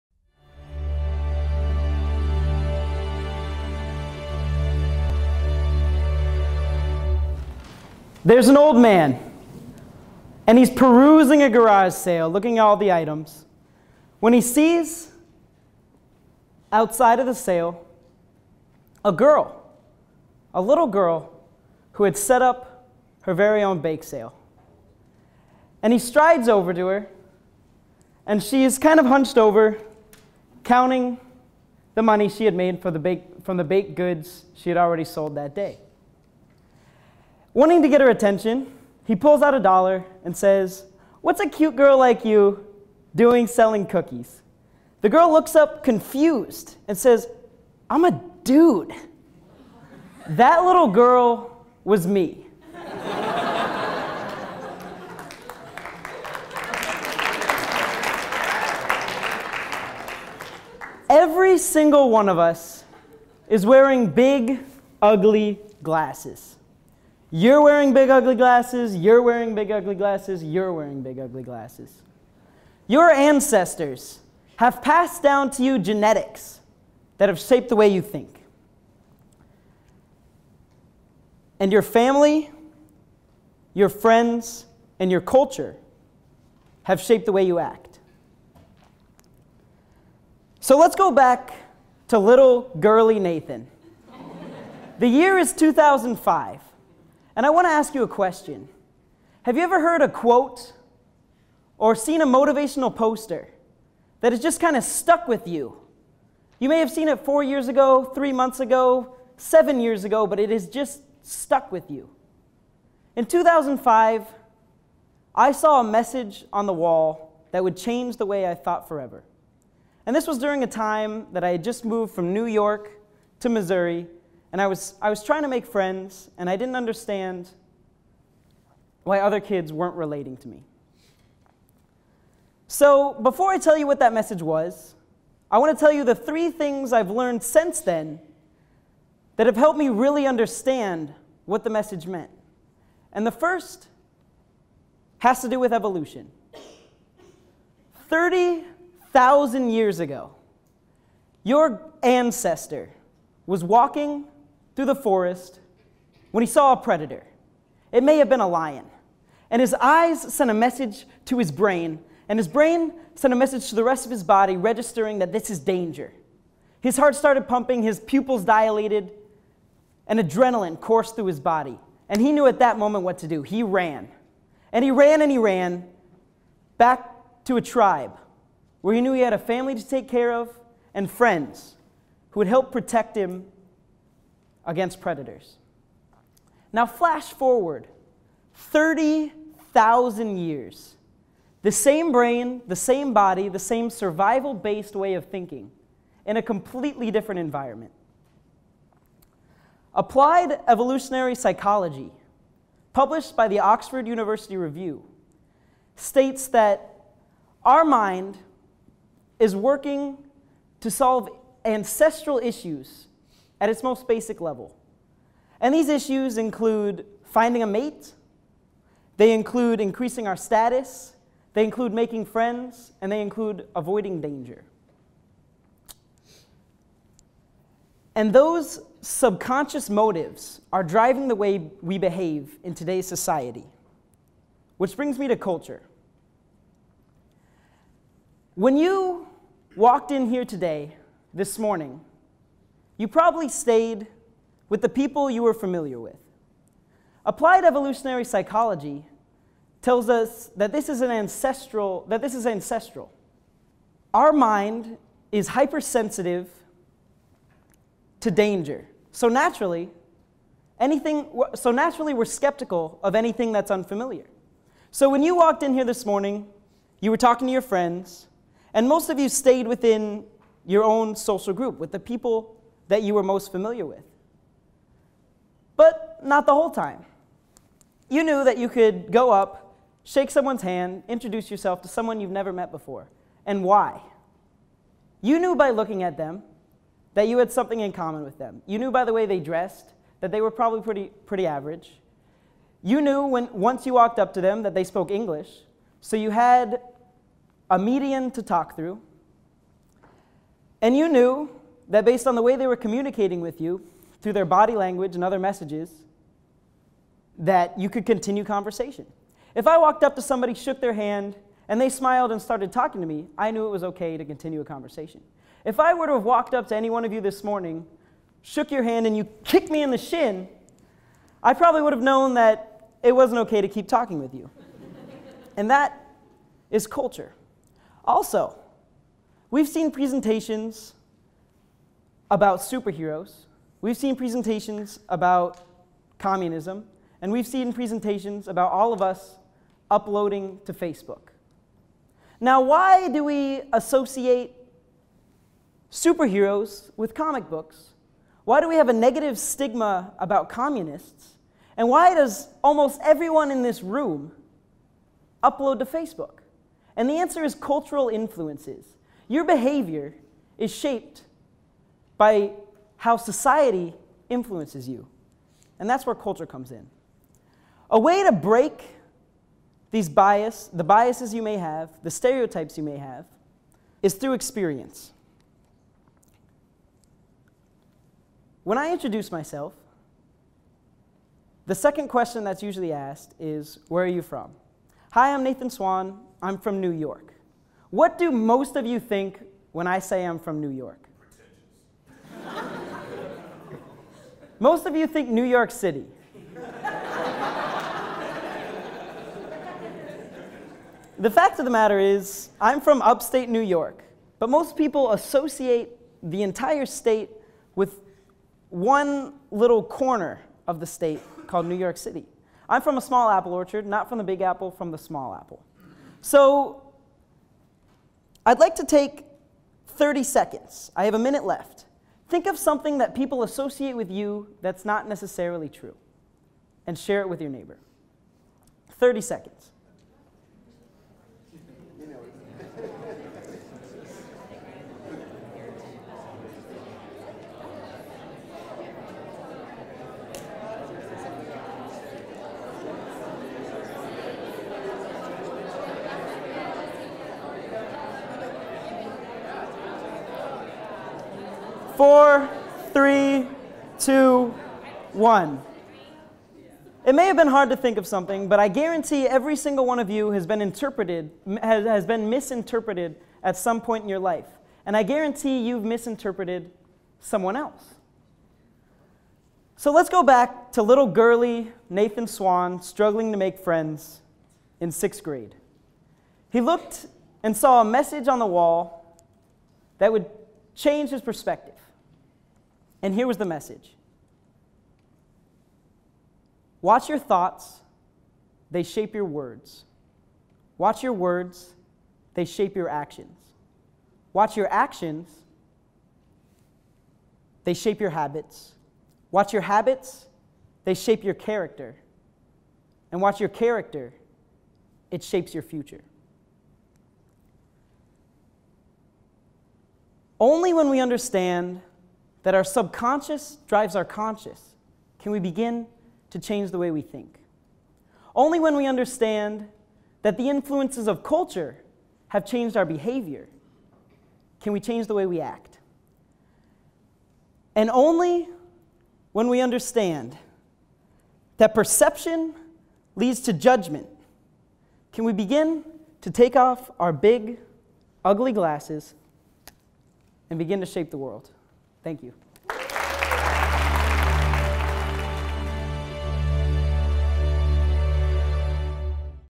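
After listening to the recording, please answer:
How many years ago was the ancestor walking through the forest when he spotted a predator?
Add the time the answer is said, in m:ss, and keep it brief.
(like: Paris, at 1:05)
30,000, at 2:28.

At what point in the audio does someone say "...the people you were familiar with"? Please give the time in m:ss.
4:04.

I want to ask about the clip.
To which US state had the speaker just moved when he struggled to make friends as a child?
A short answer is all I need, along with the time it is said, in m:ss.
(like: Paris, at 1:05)
Missouri, at 2:03.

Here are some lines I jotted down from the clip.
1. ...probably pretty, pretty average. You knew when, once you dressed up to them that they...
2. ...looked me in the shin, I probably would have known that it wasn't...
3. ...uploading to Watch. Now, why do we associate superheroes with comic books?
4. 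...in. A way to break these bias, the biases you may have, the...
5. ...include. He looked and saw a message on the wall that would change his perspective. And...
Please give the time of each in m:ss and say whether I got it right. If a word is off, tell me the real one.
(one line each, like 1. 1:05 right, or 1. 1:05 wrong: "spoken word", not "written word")
1. 4:50 wrong: "walked", not "dressed"
2. 5:19 wrong: "kicked", not "looked"
3. 5:39 wrong: "Facebook", not "Watch"
4. 6:06 right
5. 7:55 wrong: "grade", not "include".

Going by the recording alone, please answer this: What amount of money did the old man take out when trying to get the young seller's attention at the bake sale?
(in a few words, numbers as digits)
a dollar.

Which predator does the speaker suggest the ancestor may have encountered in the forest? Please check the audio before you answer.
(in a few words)
lion.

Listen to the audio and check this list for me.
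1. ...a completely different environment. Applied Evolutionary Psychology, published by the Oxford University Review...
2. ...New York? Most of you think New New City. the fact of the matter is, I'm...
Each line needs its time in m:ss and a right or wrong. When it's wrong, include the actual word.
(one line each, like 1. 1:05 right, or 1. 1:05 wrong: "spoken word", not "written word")
1. 3:16 right
2. 6:30 wrong: "York", not "New".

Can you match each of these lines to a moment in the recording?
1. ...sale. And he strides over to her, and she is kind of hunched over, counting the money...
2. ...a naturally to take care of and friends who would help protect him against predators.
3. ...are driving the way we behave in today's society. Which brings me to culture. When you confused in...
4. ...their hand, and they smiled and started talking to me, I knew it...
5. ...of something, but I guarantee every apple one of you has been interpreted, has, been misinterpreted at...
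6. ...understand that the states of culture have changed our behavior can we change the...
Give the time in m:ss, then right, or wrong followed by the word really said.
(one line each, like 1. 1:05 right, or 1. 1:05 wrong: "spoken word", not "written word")
1. 0:24 right
2. 2:59 wrong: "family", not "naturally"
3. 3:50 wrong: "walked", not "confused"
4. 5:10 right
5. 7:37 wrong: "single", not "apple"
6. 8:38 wrong: "influences", not "states".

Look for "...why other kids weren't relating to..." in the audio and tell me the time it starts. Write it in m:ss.
2:09.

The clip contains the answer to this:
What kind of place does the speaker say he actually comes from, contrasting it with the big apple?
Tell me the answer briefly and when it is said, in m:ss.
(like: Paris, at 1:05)
apple orchard, at 6:53.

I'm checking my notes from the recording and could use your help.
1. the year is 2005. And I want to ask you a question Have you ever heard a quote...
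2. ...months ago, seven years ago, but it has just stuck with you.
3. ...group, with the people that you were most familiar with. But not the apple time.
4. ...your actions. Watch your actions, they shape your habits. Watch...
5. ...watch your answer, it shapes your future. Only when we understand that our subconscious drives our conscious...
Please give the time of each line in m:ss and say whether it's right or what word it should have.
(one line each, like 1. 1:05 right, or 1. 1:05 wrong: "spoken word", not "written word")
1. 1:34 right
2. 1:48 right
3. 4:31 wrong: "whole", not "apple"
4. 8:12 right
5. 8:23 wrong: "character", not "answer".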